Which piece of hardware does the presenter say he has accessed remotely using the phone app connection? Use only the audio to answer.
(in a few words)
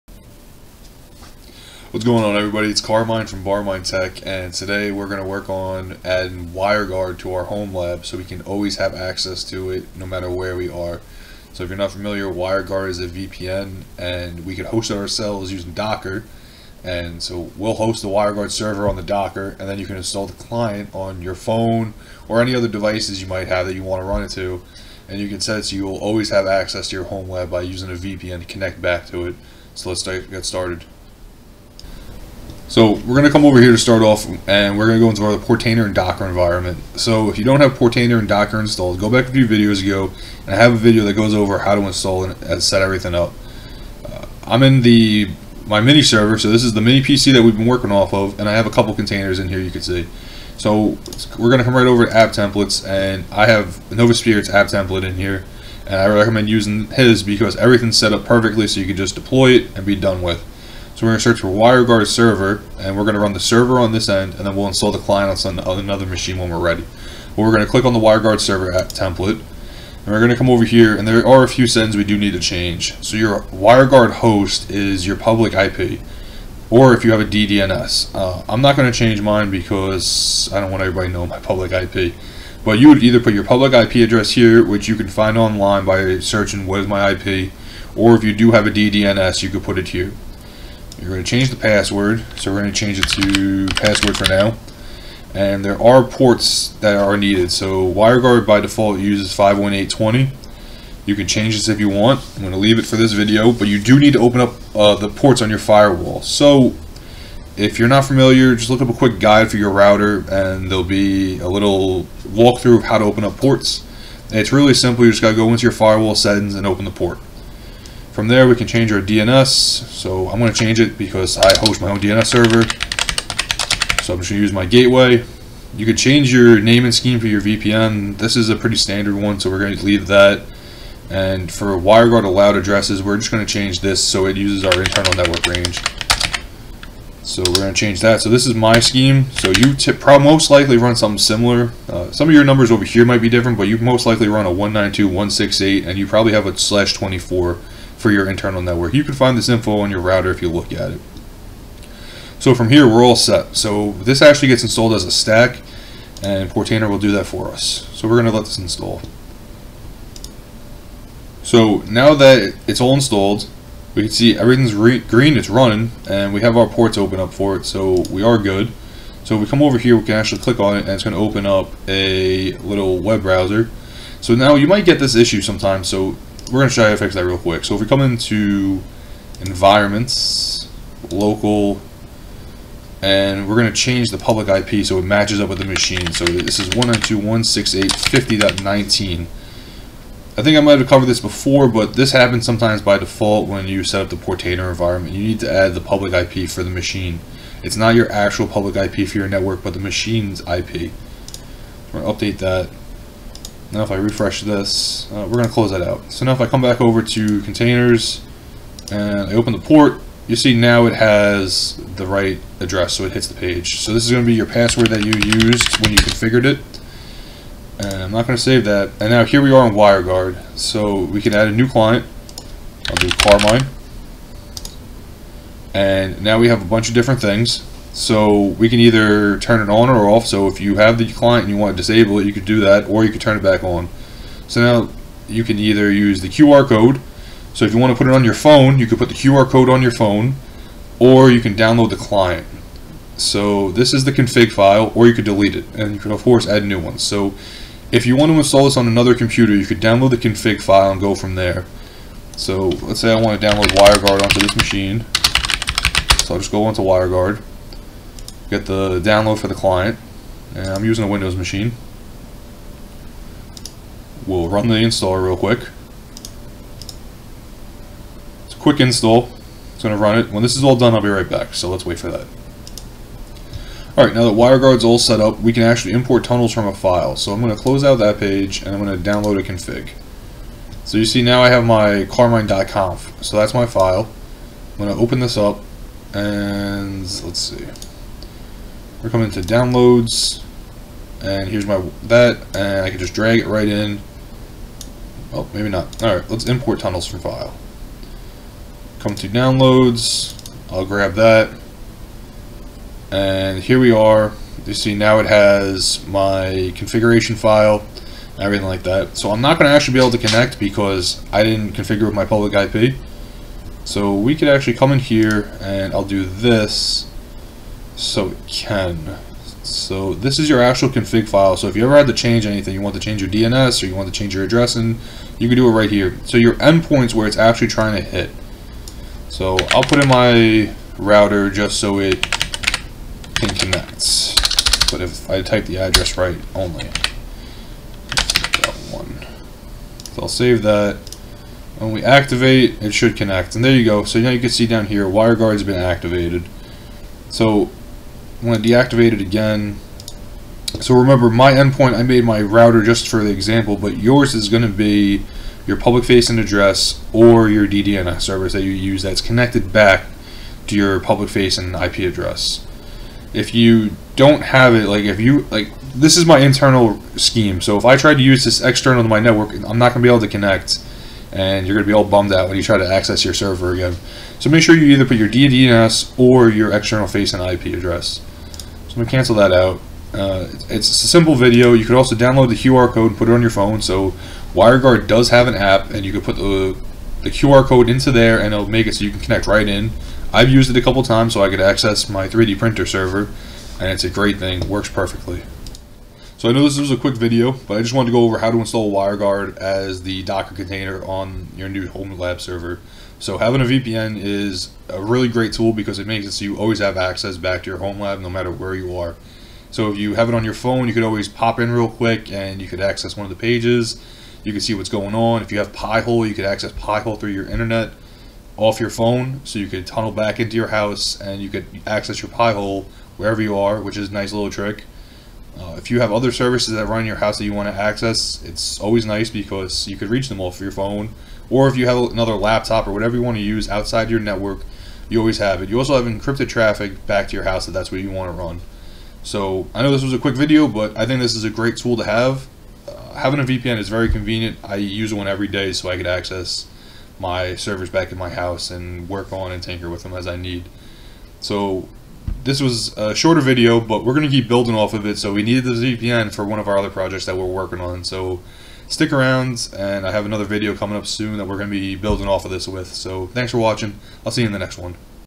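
3D printer server.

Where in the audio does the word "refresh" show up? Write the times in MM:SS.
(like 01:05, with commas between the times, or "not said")
03:23.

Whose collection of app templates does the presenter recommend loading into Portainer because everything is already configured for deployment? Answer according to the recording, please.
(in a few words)
Novaspirit.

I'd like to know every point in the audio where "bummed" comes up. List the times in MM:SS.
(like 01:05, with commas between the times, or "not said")
06:12.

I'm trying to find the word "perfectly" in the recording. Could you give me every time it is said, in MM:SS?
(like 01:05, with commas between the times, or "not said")
00:58, 06:34.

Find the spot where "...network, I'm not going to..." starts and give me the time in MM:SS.
06:09.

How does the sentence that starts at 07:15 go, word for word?
You also have encrypted traffic back to your house if that's what you want to run.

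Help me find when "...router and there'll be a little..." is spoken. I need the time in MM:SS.
01:49.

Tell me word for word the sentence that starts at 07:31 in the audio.
So this was a shorter video, but we're going to keep building off of it.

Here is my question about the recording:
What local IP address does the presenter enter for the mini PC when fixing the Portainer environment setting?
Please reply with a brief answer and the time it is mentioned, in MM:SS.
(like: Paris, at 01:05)
192.168.50.19, at 03:06.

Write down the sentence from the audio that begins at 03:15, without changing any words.
You need to add the public IP for the machine.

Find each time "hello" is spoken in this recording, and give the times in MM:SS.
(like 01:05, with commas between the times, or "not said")
not said.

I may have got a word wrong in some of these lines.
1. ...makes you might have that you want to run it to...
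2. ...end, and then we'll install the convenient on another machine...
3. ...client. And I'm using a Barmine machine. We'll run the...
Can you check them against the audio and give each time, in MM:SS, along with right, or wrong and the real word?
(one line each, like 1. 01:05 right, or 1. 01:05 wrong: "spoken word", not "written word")
1. 00:22 wrong: "devices", not "makes"
2. 01:04 wrong: "client", not "convenient"
3. 04:19 wrong: "Windows", not "Barmine".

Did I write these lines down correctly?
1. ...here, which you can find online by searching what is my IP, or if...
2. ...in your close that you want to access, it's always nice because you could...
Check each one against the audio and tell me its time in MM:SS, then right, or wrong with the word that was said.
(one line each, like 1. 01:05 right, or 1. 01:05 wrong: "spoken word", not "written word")
1. 01:24 right
2. 07:07 wrong: "house", not "close".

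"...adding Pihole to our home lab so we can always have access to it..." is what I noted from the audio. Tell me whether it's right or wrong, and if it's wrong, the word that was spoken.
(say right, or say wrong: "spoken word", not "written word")
wrong: "WireGuard", not "Pihole".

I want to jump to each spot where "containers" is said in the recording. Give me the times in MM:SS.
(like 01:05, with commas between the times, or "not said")
00:48, 03:27, 06:40.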